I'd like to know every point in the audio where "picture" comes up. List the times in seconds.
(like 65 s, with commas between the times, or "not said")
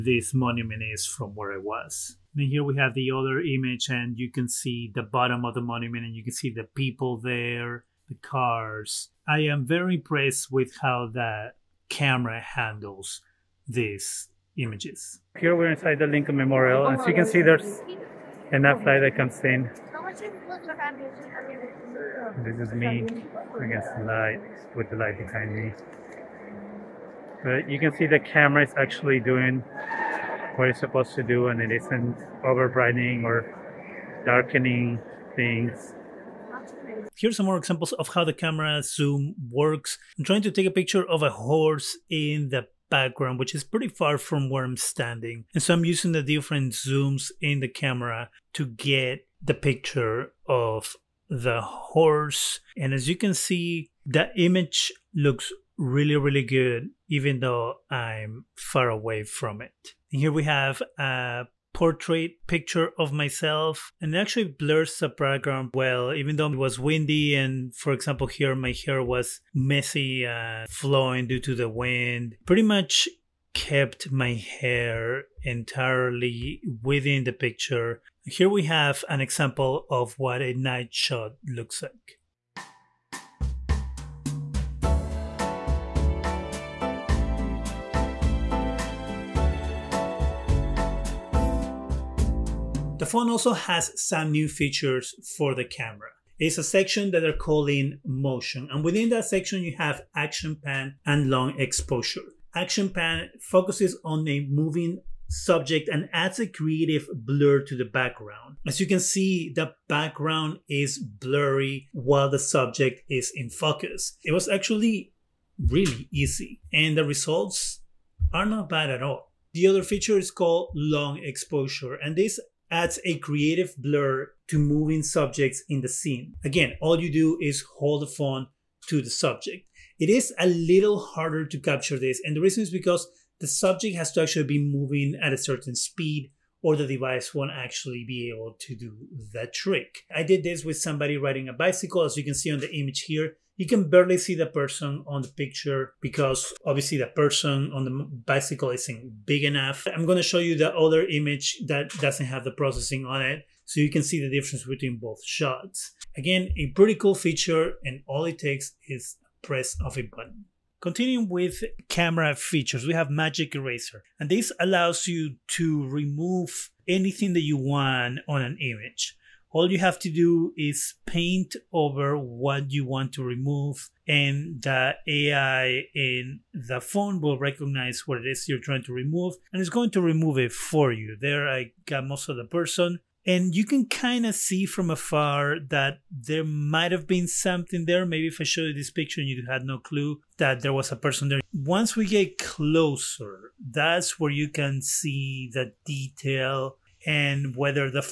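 40 s, 49 s, 62 s, 77 s, 145 s, 188 s.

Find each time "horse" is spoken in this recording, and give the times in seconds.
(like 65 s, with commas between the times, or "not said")
41 s, 51 s.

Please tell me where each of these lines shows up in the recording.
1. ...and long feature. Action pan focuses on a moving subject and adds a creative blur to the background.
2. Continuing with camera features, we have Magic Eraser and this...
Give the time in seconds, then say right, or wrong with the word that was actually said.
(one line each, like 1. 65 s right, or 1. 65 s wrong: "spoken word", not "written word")
1. 101 s wrong: "exposure", not "feature"
2. 160 s right.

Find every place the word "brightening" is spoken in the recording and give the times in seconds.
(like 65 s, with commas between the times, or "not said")
32 s.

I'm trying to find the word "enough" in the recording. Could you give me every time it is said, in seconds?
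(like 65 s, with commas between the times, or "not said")
18 s, 149 s.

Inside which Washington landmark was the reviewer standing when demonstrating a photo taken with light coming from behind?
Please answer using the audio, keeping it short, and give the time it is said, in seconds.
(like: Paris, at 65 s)
Lincoln Memorial, at 16 s.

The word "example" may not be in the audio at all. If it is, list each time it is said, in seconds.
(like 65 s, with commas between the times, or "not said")
37 s, 67 s, 79 s.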